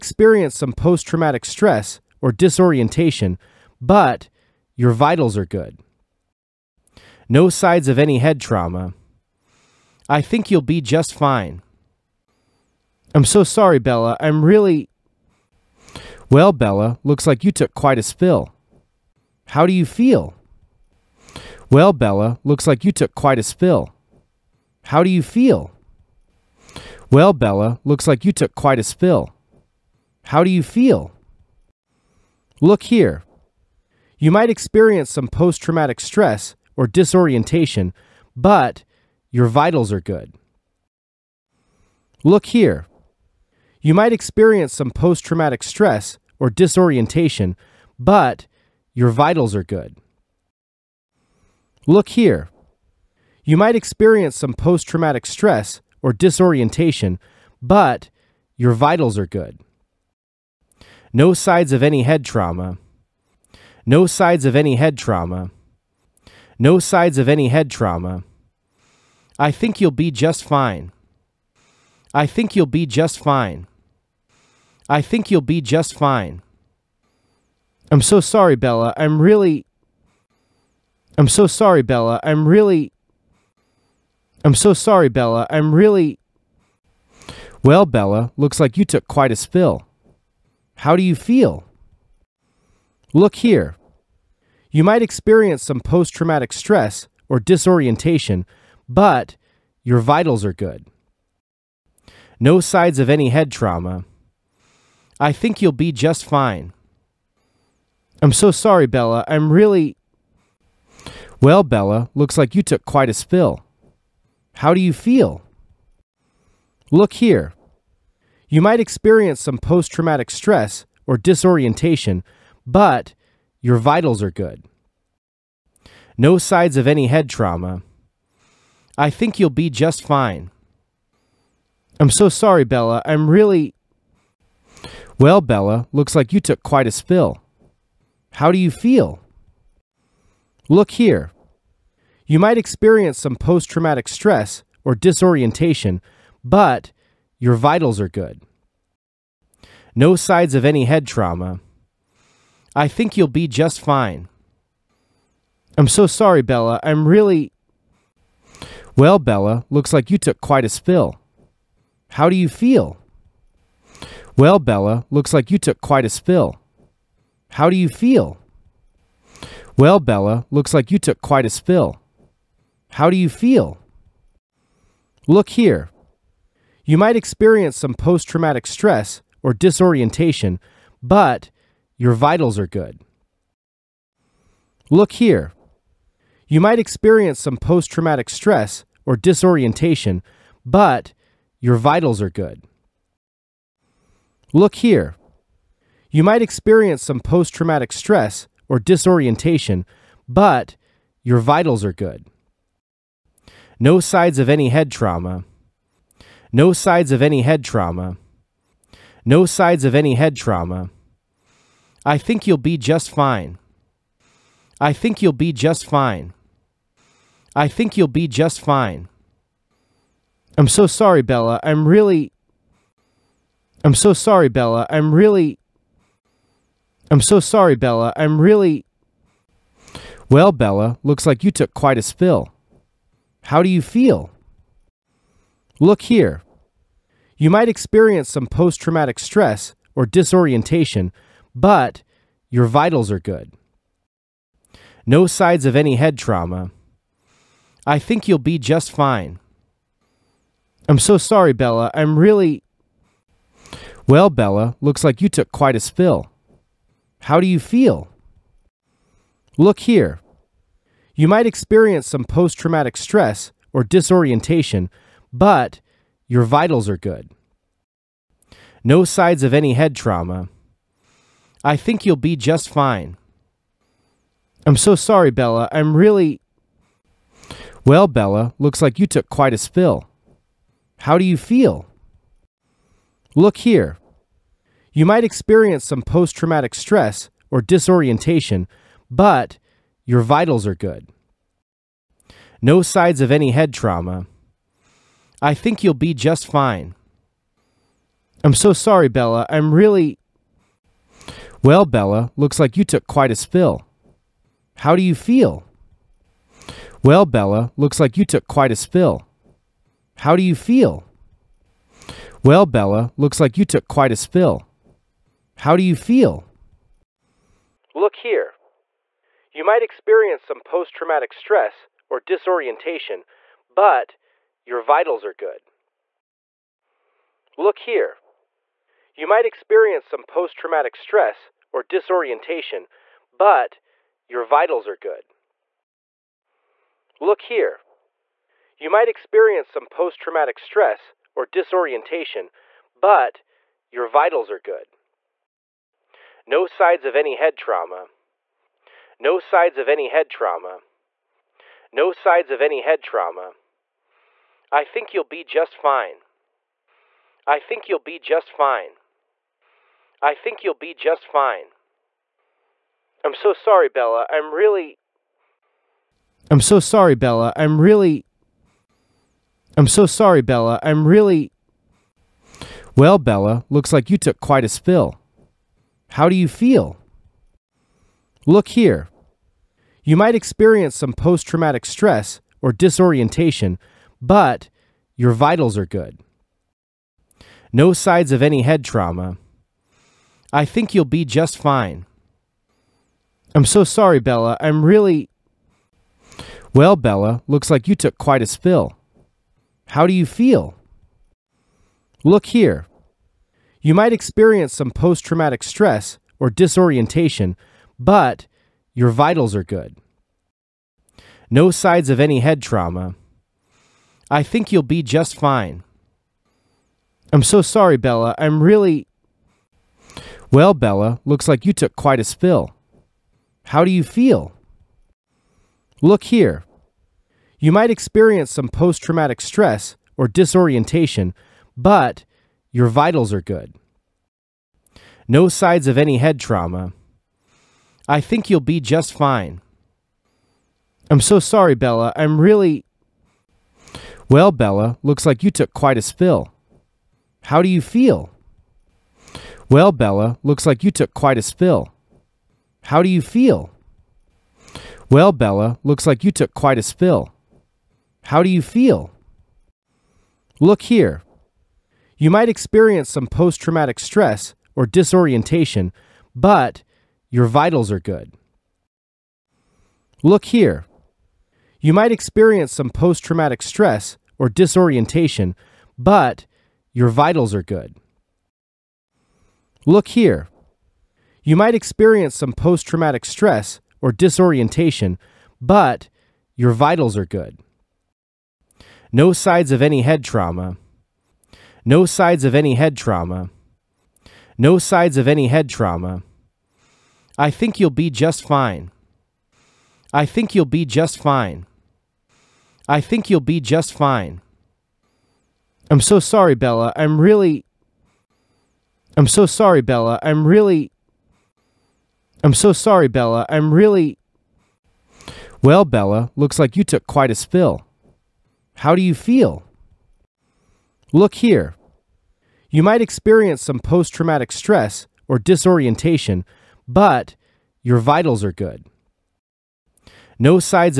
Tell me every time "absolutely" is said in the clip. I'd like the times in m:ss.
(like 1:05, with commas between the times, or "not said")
not said.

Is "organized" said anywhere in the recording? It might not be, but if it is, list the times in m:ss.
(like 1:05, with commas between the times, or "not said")
not said.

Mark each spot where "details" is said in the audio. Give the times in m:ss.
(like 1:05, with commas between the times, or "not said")
not said.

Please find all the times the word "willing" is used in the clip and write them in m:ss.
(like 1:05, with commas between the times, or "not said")
not said.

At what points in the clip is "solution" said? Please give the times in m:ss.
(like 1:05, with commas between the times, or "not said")
not said.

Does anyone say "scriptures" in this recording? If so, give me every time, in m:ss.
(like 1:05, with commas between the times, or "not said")
not said.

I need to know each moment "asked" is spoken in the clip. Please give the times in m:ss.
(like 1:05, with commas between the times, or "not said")
not said.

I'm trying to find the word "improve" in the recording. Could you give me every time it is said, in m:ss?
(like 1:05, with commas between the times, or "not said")
not said.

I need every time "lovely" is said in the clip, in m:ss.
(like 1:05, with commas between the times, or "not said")
not said.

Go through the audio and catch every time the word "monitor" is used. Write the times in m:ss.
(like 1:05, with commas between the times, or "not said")
not said.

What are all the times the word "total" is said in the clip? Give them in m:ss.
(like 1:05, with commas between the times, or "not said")
not said.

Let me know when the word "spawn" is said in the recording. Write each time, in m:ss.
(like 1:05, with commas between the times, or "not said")
not said.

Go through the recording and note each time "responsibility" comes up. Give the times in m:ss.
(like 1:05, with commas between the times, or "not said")
not said.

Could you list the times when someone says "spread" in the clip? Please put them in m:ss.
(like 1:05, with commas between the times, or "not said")
not said.